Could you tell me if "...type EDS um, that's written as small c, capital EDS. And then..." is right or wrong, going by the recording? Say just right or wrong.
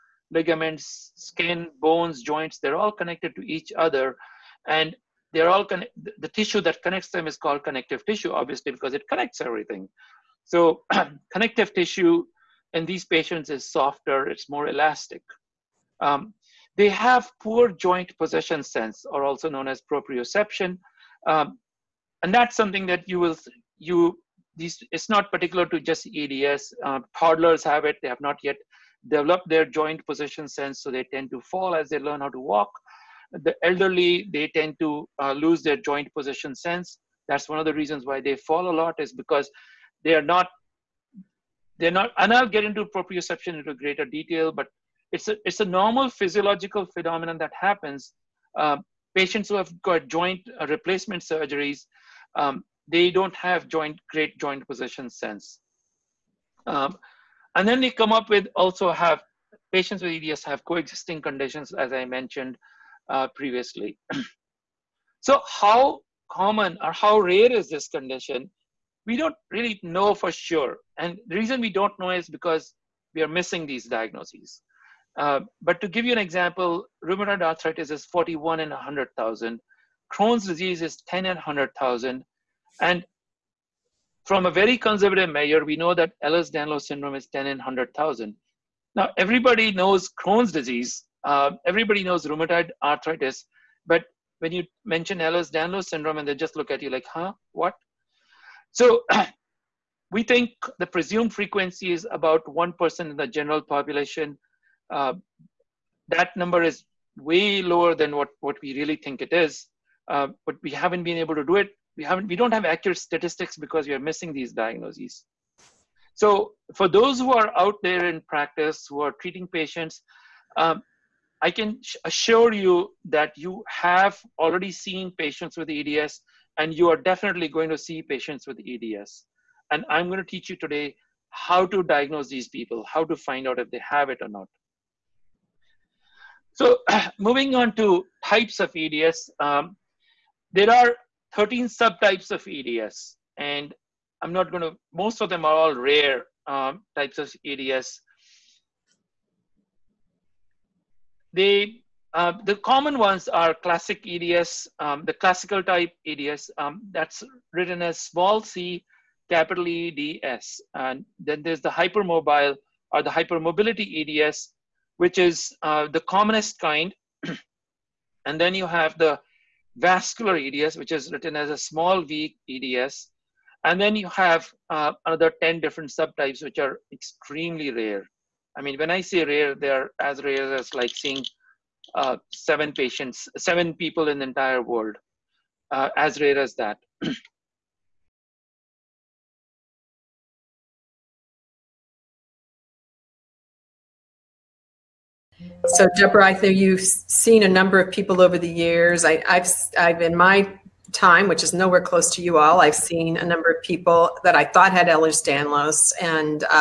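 right.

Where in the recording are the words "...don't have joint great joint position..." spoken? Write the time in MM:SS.
00:53.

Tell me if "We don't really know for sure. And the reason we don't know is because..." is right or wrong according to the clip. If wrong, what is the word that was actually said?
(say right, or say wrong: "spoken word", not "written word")
right.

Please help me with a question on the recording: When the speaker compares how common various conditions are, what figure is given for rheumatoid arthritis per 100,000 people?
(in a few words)
41 in 100,000.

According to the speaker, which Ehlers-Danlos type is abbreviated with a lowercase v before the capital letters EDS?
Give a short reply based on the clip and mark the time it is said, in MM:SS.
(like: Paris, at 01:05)
Vascular EDS, at 02:49.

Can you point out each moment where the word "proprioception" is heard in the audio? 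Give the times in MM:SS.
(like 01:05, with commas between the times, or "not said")
00:19, 00:42.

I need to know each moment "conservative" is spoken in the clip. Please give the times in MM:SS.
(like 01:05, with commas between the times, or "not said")
01:24.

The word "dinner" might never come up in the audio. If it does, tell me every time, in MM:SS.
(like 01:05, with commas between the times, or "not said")
not said.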